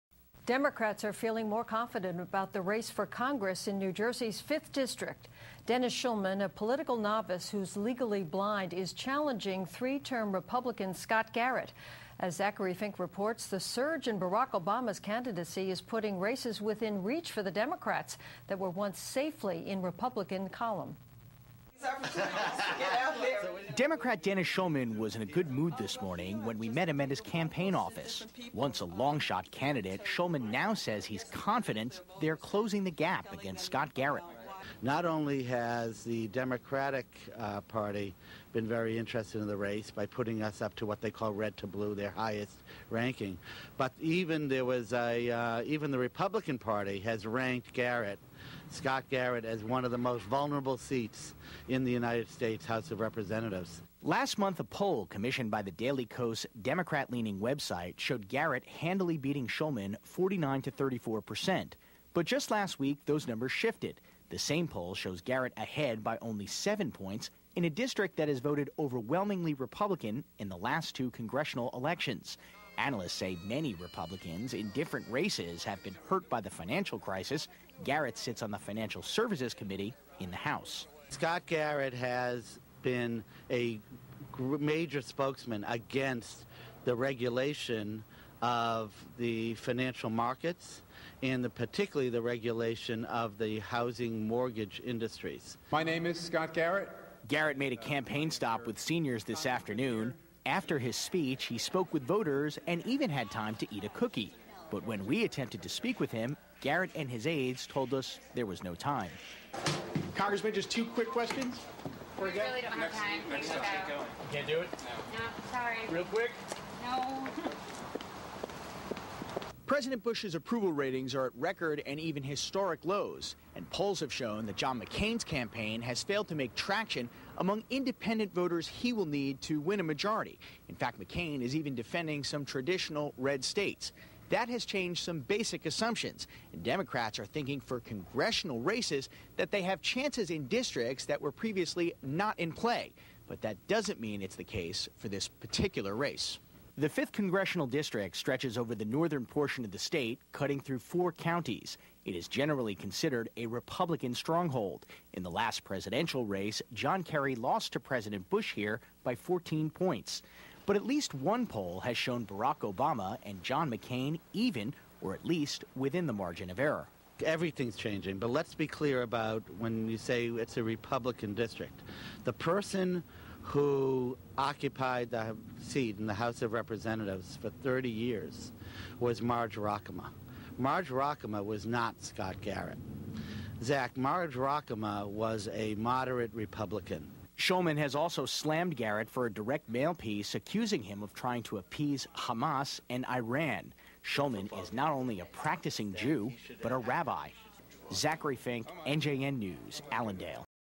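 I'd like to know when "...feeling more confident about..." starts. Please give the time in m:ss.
0:01.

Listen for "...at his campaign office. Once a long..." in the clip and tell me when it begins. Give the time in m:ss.
0:27.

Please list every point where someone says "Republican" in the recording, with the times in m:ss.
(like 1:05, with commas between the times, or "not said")
0:10, 0:19, 0:45, 1:09, 1:13, 2:33, 2:50, 3:06.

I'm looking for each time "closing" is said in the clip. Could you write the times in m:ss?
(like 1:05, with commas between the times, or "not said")
0:32.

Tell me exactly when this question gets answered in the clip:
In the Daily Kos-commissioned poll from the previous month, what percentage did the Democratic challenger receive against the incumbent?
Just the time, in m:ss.
1:00.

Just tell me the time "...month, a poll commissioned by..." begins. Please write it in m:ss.
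0:54.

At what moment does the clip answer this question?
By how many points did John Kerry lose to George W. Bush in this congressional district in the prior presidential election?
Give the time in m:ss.
2:39.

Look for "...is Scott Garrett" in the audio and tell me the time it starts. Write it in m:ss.
1:36.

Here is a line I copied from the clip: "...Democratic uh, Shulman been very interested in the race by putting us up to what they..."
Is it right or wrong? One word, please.
wrong.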